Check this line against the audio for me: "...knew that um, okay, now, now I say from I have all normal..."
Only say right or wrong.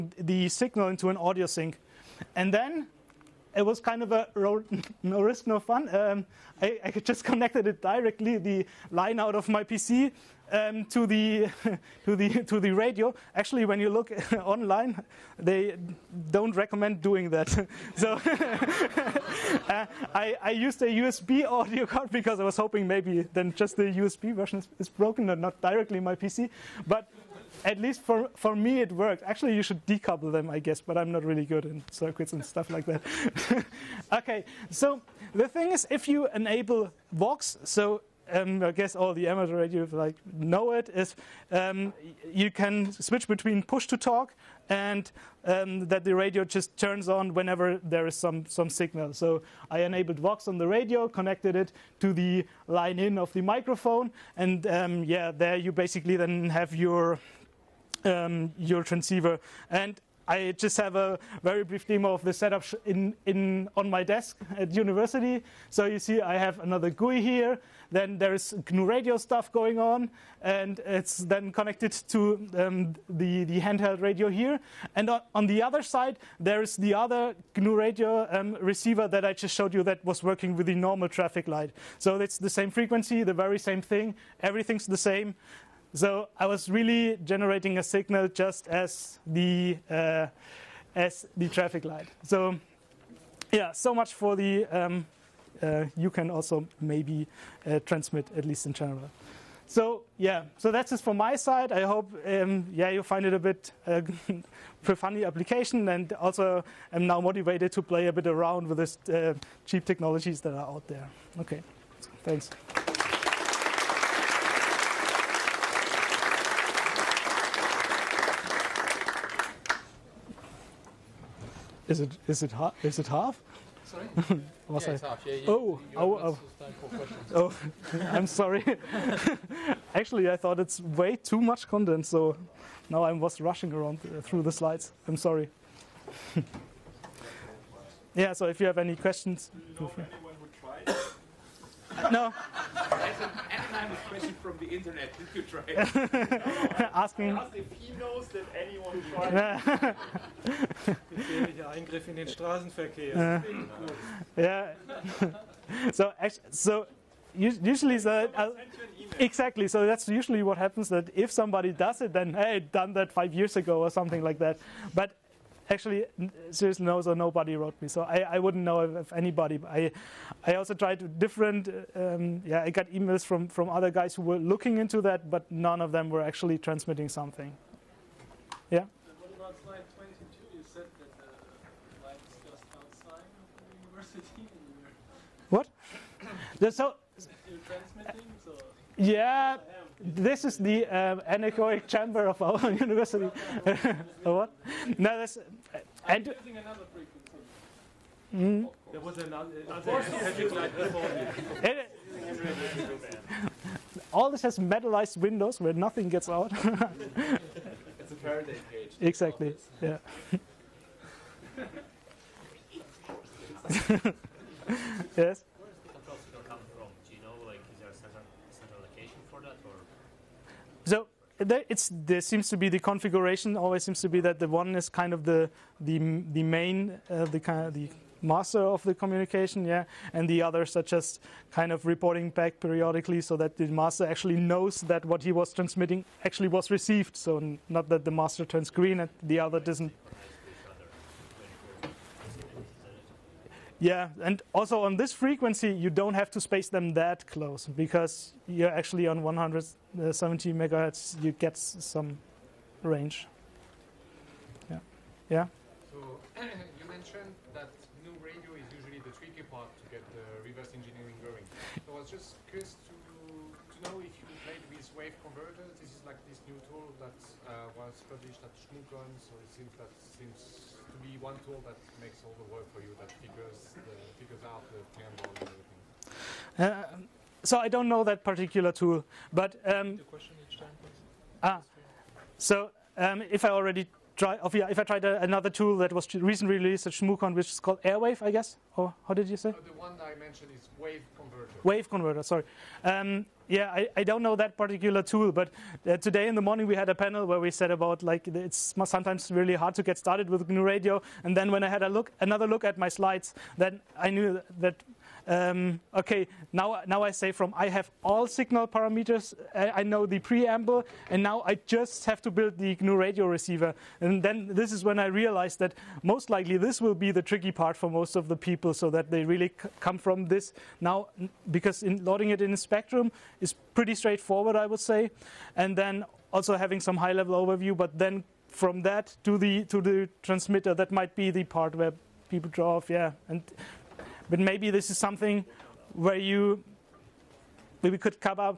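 wrong.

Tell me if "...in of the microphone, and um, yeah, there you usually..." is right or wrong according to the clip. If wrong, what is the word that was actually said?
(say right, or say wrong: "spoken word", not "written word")
wrong: "basically", not "usually".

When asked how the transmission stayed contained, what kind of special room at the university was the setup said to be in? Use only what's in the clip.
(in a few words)
anechoic chamber.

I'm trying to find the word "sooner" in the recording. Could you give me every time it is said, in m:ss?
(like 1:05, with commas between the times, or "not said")
not said.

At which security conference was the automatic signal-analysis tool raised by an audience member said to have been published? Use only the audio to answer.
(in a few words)
ShmooCon.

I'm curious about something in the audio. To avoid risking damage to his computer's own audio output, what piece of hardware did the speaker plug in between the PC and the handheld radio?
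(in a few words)
USB audio card.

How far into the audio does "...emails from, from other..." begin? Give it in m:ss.
2:52.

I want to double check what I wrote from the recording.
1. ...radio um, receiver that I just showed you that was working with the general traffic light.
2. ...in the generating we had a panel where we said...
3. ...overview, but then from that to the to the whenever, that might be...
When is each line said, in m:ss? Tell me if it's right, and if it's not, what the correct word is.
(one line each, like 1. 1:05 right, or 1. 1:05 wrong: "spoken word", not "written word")
1. 1:17 wrong: "normal", not "general"
2. 4:56 wrong: "morning", not "generating"
3. 5:27 wrong: "transmitter", not "whenever".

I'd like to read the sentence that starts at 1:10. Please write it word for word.
And it's then connected to um, the, the handheld radio here.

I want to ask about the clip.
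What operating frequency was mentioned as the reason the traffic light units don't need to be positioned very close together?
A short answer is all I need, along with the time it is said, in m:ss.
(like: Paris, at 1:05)
170 MHz, at 4:09.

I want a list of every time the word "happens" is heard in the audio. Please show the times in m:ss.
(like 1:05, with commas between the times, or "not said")
2:40.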